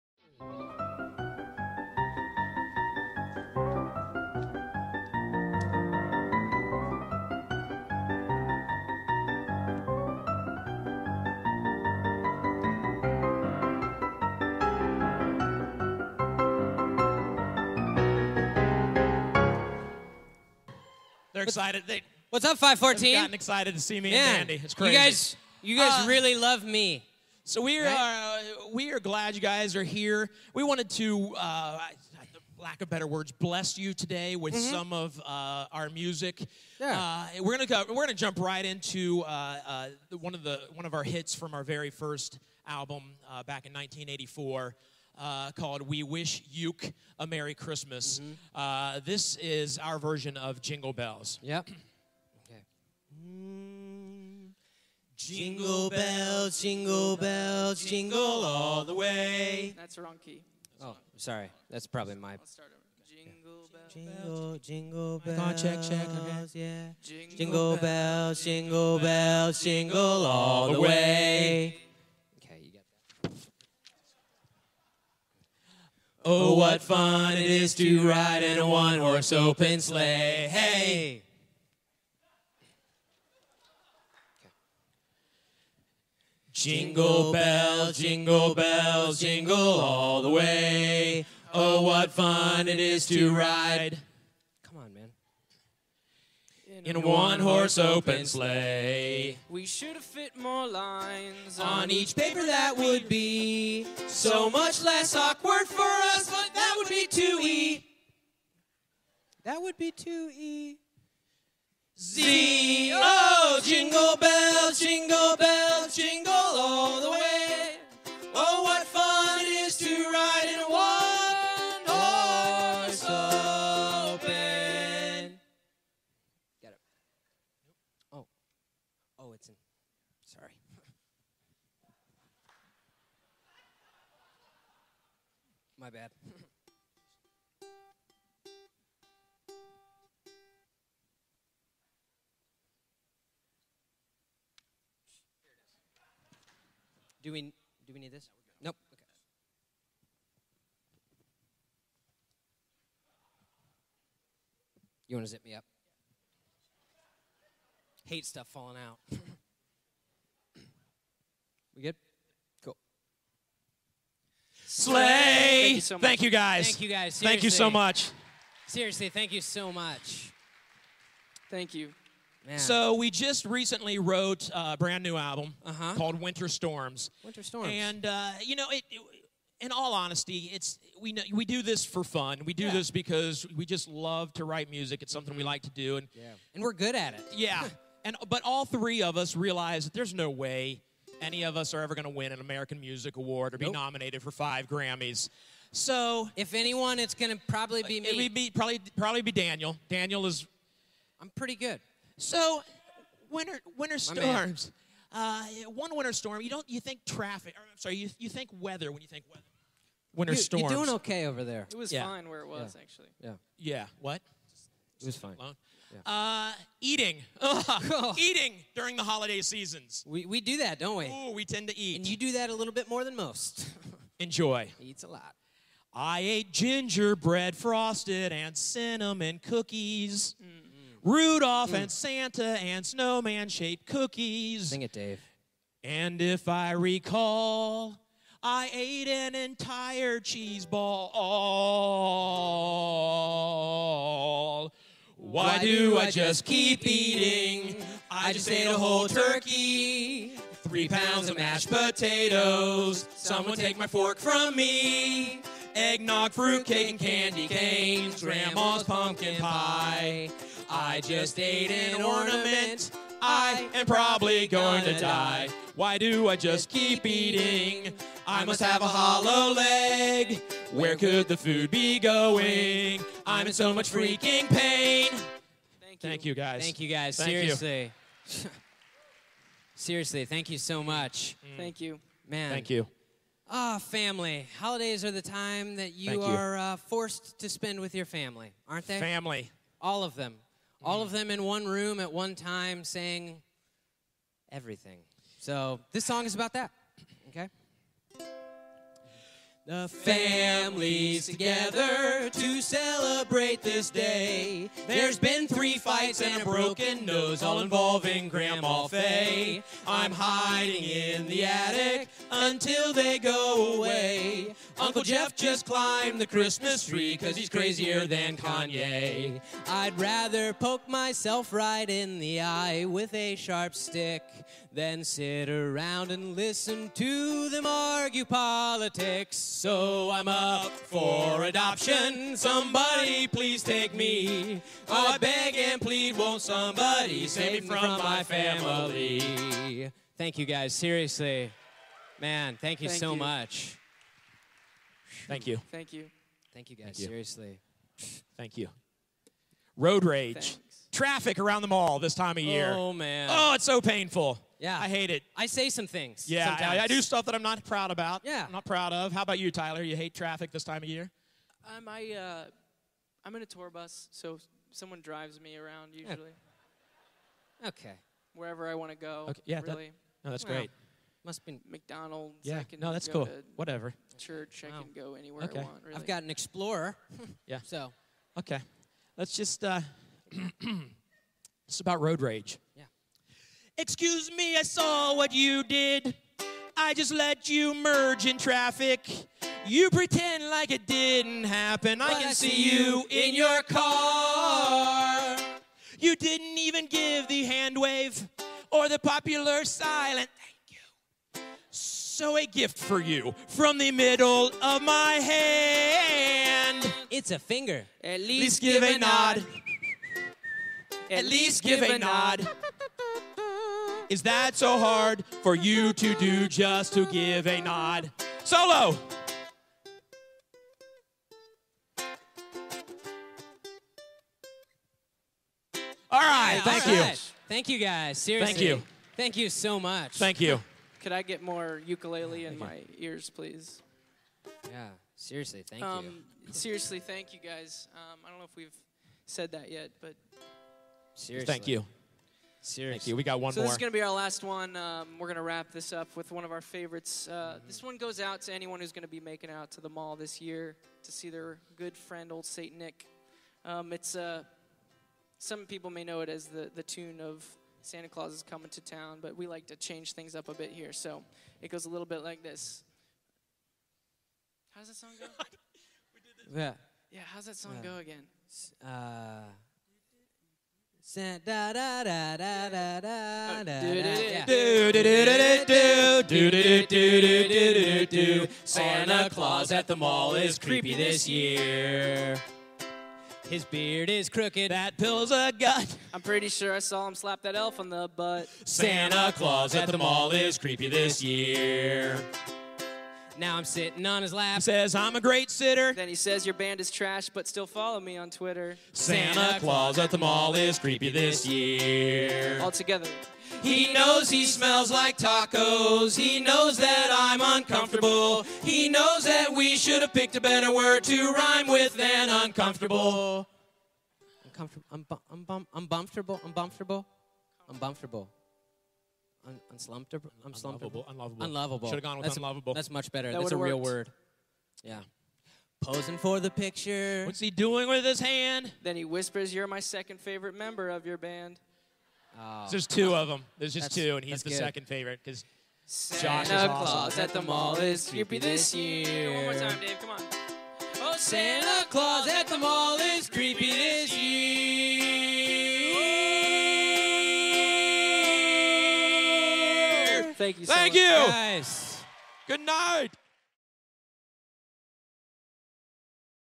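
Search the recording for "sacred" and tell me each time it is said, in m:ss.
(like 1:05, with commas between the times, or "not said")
not said.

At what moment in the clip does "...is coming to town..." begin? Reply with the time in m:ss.
7:38.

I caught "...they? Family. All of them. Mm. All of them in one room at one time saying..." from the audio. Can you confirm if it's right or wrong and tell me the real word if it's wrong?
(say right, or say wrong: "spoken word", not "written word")
right.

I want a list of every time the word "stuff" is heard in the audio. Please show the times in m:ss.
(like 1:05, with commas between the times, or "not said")
2:38, 5:57.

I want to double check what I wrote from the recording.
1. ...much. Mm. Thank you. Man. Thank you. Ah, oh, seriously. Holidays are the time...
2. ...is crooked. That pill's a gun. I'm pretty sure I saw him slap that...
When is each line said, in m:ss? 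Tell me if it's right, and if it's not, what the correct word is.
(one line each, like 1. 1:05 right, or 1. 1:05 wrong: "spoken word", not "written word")
1. 4:40 wrong: "family", not "seriously"
2. 8:04 right.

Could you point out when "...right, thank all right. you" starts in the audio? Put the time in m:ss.
7:06.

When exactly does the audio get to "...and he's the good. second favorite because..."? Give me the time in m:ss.
8:54.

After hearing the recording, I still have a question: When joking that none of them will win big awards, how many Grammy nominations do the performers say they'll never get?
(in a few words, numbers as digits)
5.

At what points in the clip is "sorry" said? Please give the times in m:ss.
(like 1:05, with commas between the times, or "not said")
1:01, 2:10, 3:27.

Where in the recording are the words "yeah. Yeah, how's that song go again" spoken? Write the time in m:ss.
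7:46.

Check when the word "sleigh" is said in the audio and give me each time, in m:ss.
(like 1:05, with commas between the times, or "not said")
1:19, 1:38.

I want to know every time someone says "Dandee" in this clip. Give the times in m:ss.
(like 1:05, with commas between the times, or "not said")
0:24.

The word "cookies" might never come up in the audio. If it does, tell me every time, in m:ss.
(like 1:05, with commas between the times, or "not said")
3:49, 3:53.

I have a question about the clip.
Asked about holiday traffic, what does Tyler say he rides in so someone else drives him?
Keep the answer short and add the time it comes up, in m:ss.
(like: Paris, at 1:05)
A tour bus, at 6:03.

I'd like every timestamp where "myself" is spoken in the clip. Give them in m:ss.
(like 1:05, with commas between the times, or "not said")
5:20.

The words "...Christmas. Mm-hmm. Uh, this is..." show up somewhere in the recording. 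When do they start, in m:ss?
0:47.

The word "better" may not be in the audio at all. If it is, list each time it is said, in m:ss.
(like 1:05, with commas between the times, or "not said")
0:32, 8:30, 8:43.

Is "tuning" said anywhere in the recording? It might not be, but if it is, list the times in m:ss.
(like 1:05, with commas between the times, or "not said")
not said.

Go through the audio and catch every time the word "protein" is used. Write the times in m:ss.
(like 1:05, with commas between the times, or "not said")
not said.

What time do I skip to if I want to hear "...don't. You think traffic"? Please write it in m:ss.
3:26.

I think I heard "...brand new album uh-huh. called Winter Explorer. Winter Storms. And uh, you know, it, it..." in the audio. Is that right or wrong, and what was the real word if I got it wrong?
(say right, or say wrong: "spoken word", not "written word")
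wrong: "Storms", not "Explorer".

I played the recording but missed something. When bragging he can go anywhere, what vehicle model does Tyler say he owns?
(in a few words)
Explorer.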